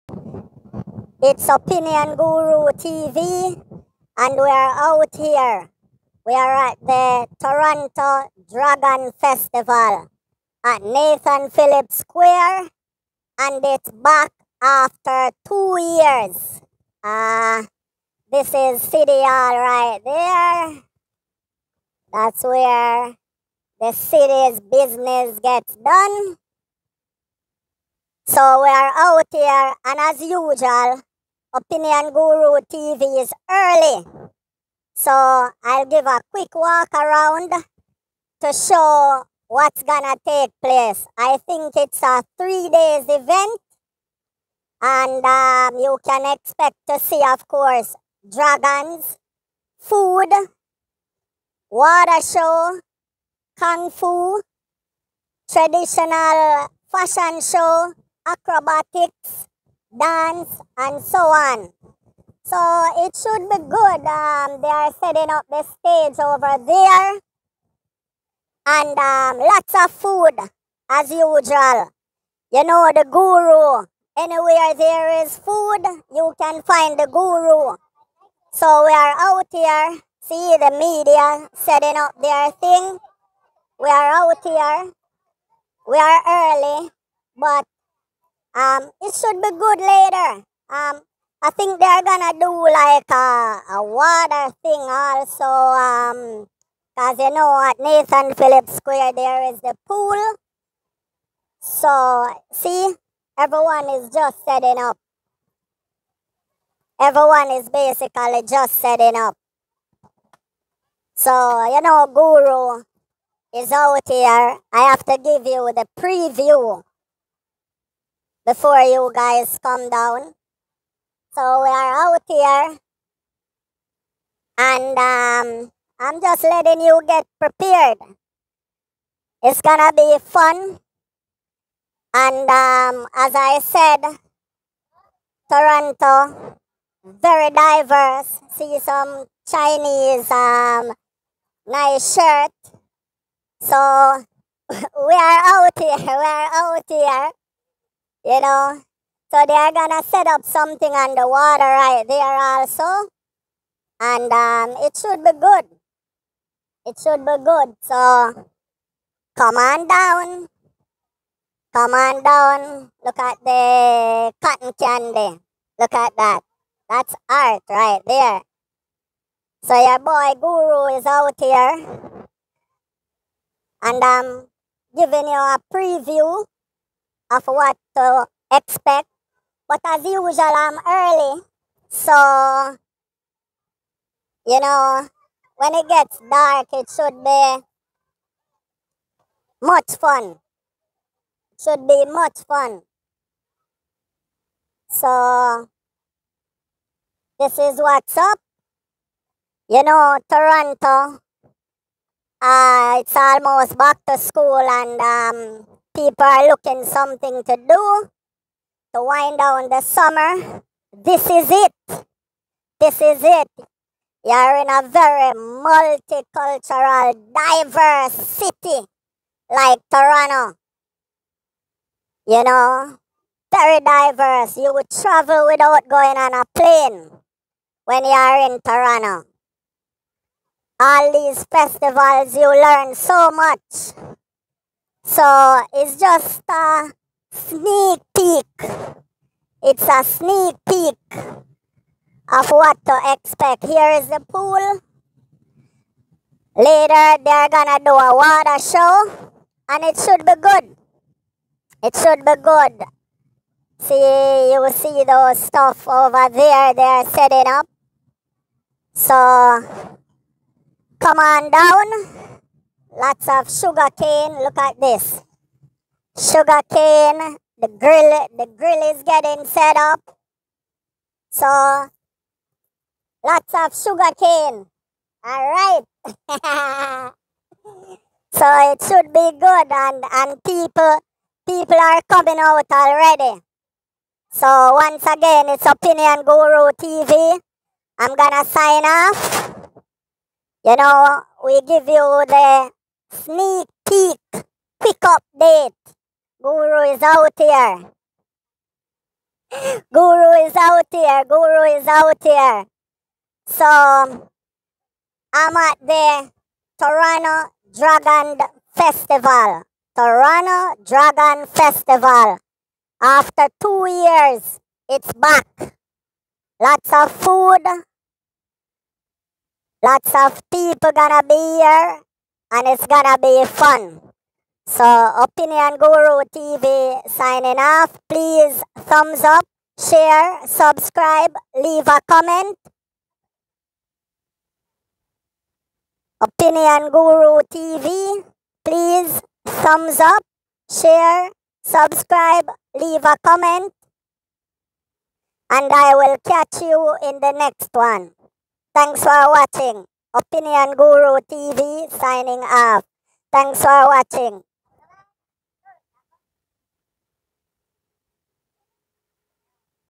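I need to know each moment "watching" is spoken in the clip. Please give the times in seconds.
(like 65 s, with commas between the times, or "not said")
349 s, 353 s.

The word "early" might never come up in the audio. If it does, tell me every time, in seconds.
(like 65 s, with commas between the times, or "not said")
33 s, 86 s, 180 s.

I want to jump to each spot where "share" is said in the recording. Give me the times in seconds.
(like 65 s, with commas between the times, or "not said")
329 s, 340 s.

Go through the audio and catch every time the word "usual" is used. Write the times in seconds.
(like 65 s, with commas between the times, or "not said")
30 s, 71 s, 180 s.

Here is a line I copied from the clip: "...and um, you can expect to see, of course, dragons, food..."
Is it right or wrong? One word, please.
right.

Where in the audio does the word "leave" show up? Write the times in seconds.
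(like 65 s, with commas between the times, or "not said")
331 s, 342 s.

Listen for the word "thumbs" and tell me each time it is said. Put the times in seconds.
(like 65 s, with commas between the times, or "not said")
328 s, 339 s.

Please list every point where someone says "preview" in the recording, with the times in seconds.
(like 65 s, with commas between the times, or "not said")
115 s, 175 s.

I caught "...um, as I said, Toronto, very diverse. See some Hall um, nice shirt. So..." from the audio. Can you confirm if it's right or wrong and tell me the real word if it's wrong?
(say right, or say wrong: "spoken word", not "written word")
wrong: "Chinese", not "Hall".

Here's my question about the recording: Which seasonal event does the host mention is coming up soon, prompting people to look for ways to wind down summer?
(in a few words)
back to school.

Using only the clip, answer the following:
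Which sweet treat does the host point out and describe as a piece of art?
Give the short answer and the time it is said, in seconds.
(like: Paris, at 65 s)
cotton candy, at 164 s.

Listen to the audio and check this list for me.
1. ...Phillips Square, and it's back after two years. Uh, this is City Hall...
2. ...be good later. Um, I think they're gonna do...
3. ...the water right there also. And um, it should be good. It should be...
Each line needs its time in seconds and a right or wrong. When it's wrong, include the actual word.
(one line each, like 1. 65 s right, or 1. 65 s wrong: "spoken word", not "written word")
1. 11 s right
2. 89 s right
3. 151 s right.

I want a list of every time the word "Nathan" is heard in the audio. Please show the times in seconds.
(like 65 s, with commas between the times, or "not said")
10 s, 97 s.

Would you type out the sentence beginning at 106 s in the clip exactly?
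Everyone is basically just setting up.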